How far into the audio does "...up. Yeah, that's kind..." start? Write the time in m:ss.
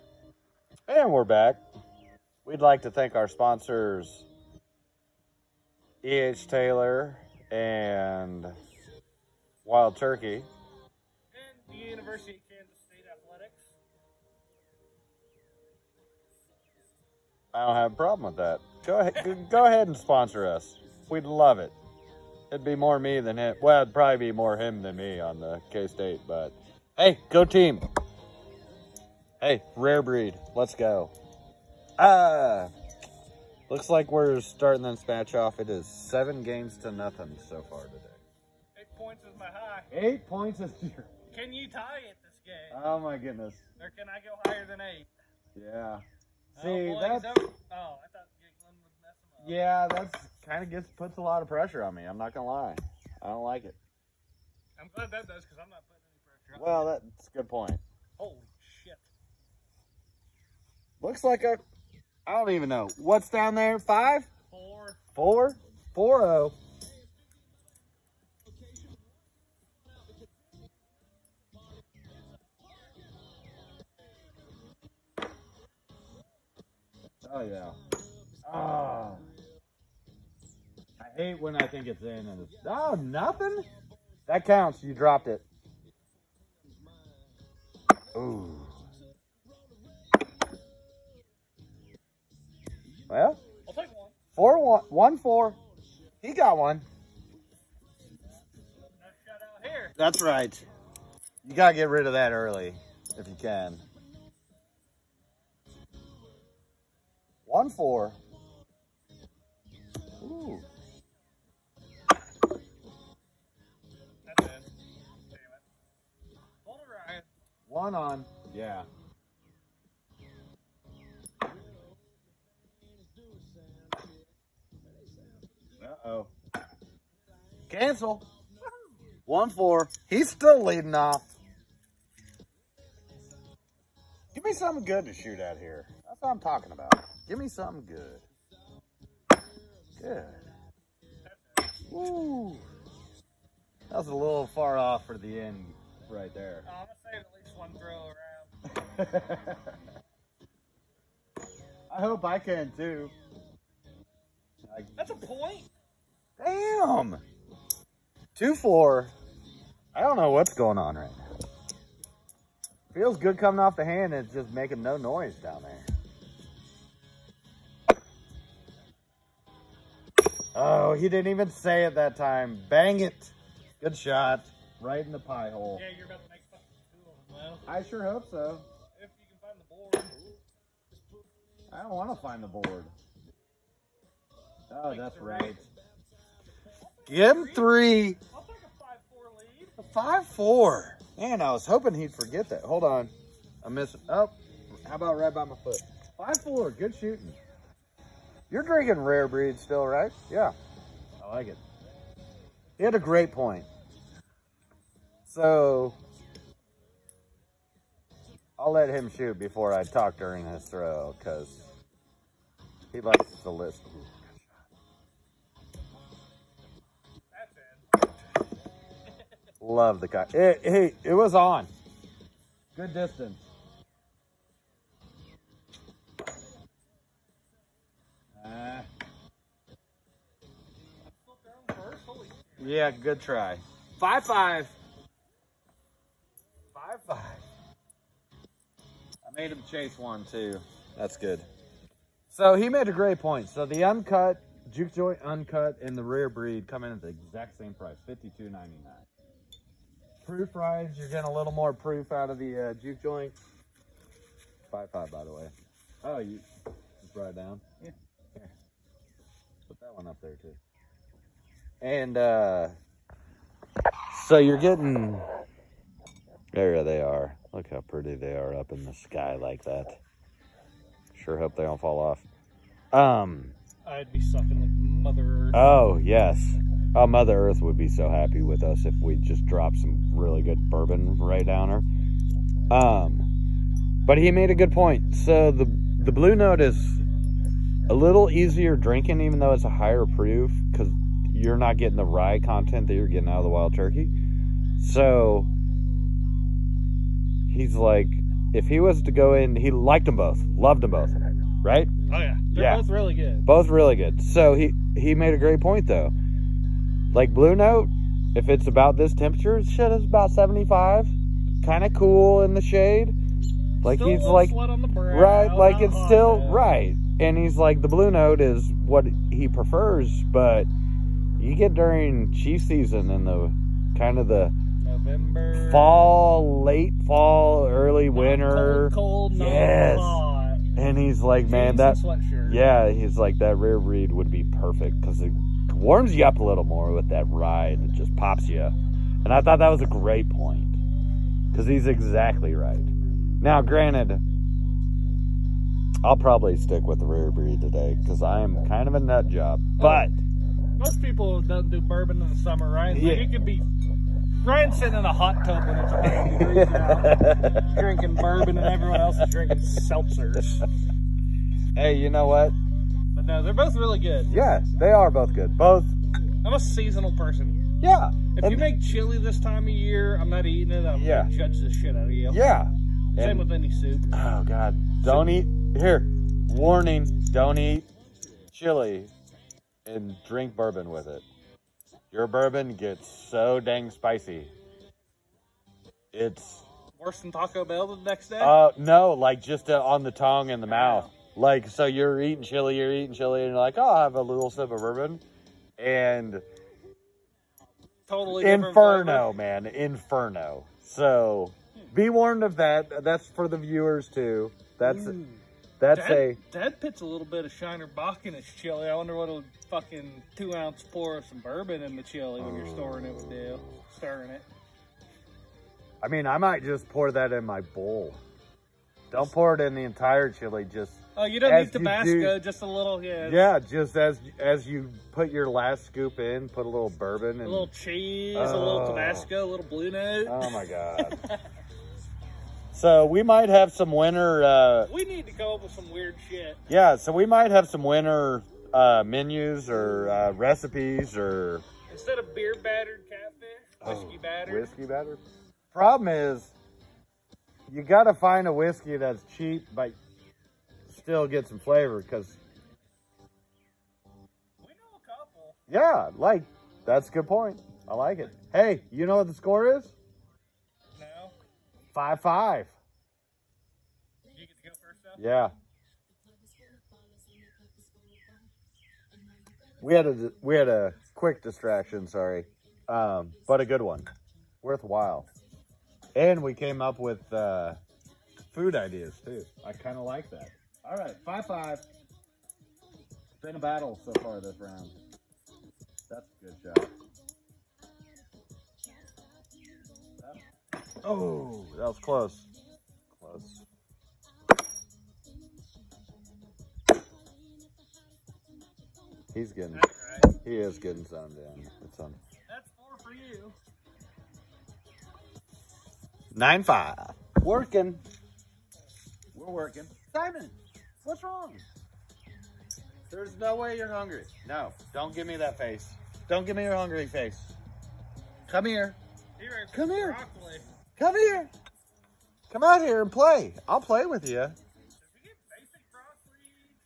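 0:49.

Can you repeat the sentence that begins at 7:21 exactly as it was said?
Instead of beer battered catfish, oh, whiskey oh, battered.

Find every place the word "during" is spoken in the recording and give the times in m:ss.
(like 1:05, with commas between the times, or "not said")
3:30, 5:21.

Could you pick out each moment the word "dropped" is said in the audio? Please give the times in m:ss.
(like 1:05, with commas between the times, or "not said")
1:24, 4:39.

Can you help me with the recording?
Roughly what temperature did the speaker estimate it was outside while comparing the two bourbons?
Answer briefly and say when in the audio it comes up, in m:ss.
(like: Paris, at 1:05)
75, at 5:09.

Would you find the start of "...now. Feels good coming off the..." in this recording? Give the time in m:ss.
2:41.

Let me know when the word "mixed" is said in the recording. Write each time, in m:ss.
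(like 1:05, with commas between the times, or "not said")
not said.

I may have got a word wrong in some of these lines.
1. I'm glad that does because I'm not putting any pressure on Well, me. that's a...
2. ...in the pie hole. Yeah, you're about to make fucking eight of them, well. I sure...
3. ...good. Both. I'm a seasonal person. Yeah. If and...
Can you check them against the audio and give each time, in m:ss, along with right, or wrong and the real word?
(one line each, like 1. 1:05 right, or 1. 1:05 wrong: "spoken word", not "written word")
1. 0:54 right
2. 2:55 wrong: "two", not "eight"
3. 6:05 right.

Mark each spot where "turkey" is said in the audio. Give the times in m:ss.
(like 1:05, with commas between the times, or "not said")
0:09, 4:53.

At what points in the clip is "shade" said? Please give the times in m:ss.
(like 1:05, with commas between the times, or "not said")
5:12.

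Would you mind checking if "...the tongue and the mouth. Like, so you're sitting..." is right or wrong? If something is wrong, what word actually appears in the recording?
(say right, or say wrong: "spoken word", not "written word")
wrong: "eating", not "sitting".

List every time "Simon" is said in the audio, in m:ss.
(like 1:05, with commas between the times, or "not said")
8:30.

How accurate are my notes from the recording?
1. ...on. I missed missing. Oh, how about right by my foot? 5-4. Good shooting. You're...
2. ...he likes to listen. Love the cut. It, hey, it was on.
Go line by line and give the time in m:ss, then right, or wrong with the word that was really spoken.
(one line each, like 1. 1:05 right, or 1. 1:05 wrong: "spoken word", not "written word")
1. 3:12 right
2. 3:32 right.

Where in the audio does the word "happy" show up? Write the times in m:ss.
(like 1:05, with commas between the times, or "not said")
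4:38.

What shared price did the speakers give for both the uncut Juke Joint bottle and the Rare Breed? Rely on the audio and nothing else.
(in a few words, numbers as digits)
52.99.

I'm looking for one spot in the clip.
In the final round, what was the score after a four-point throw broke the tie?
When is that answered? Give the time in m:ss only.
8:26.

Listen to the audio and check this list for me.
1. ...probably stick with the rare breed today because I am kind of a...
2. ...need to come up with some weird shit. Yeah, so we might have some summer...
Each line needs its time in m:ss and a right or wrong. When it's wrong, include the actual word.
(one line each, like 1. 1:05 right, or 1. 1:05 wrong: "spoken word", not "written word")
1. 5:46 right
2. 7:15 wrong: "winter", not "summer".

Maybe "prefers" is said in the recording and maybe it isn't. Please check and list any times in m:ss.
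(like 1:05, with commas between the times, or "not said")
5:19.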